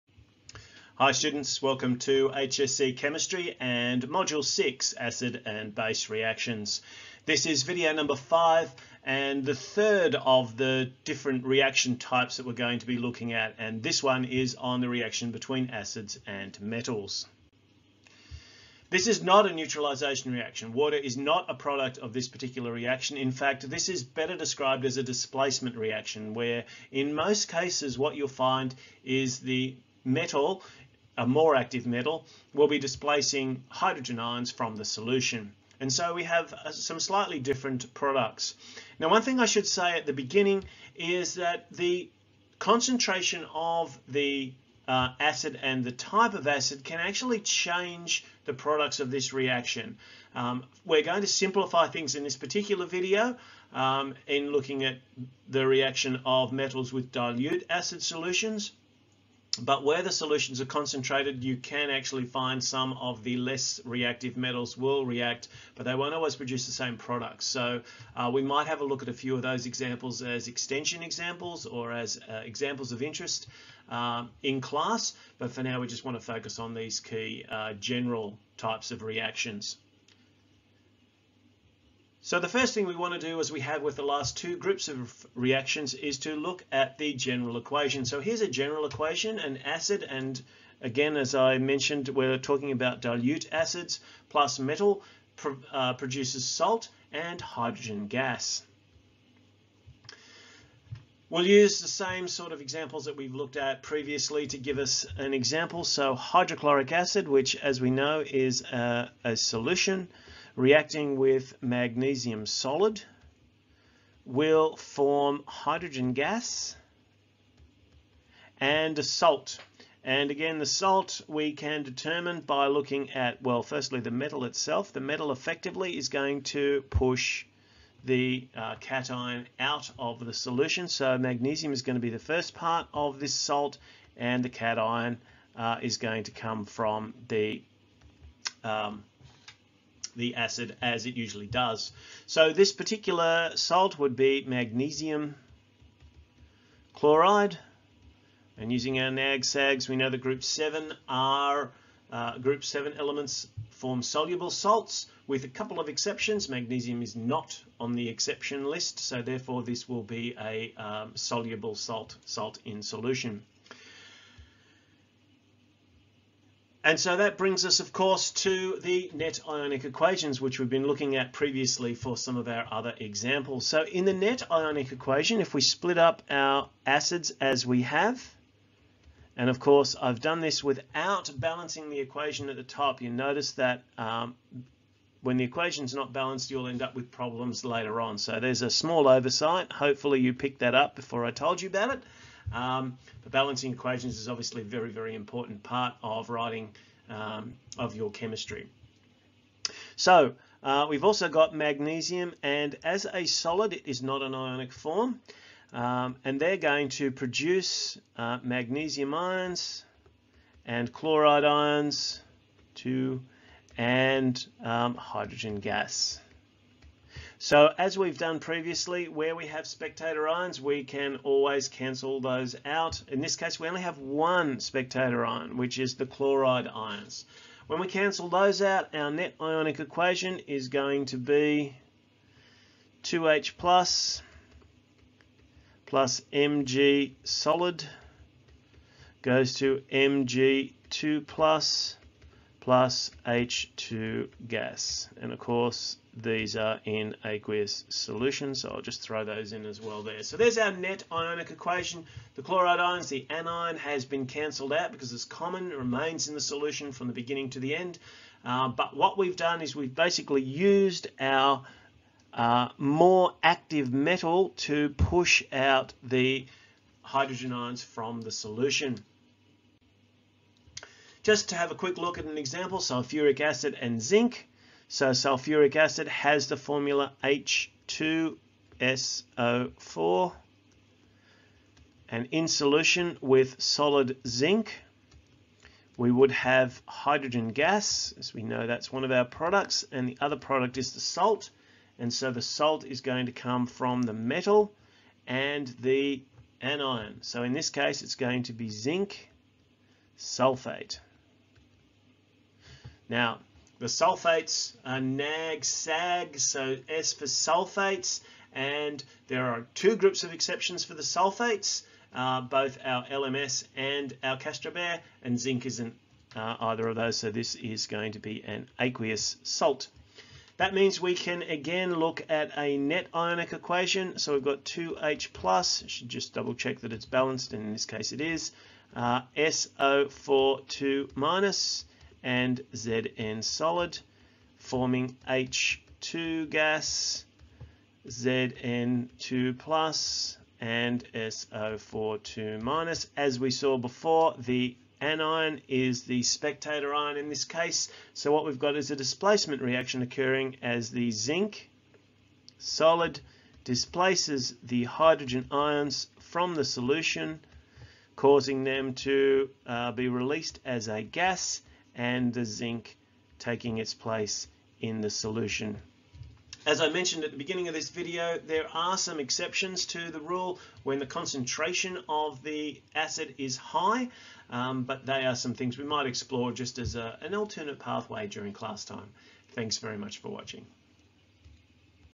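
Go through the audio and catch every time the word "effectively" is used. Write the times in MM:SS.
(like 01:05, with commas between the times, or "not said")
02:05.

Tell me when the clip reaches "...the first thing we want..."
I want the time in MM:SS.
01:22.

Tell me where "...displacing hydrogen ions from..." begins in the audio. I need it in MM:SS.
00:32.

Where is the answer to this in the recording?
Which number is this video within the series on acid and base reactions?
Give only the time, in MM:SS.
00:07.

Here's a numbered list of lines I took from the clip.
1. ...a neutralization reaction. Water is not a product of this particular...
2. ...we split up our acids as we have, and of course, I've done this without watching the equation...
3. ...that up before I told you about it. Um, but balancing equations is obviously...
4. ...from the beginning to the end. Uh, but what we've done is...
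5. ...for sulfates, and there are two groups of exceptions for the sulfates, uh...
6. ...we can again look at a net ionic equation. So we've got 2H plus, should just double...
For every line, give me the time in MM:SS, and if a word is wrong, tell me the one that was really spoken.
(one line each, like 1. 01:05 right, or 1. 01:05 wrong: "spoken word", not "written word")
1. 00:19 right
2. 02:55 wrong: "balancing", not "watching"
3. 03:10 right
4. 04:16 right
5. 05:07 right
6. 05:21 right.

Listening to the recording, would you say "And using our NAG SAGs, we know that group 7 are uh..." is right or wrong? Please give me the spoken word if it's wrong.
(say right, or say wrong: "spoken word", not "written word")
right.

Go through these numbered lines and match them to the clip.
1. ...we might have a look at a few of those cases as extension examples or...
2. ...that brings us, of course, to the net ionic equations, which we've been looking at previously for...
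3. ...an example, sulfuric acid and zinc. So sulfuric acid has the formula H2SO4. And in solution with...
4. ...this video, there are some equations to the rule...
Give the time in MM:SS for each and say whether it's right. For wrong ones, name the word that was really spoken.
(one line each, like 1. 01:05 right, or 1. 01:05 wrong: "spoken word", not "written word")
1. 01:08 wrong: "examples", not "cases"
2. 02:47 right
3. 04:32 right
4. 06:07 wrong: "exceptions", not "equations".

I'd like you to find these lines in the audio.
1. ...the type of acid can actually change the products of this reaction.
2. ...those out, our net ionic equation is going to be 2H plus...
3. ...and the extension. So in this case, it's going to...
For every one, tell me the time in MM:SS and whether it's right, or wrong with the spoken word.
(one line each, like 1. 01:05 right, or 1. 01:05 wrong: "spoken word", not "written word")
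1. 00:45 right
2. 03:48 right
3. 04:55 wrong: "anion", not "extension".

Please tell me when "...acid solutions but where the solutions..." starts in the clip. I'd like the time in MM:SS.
00:57.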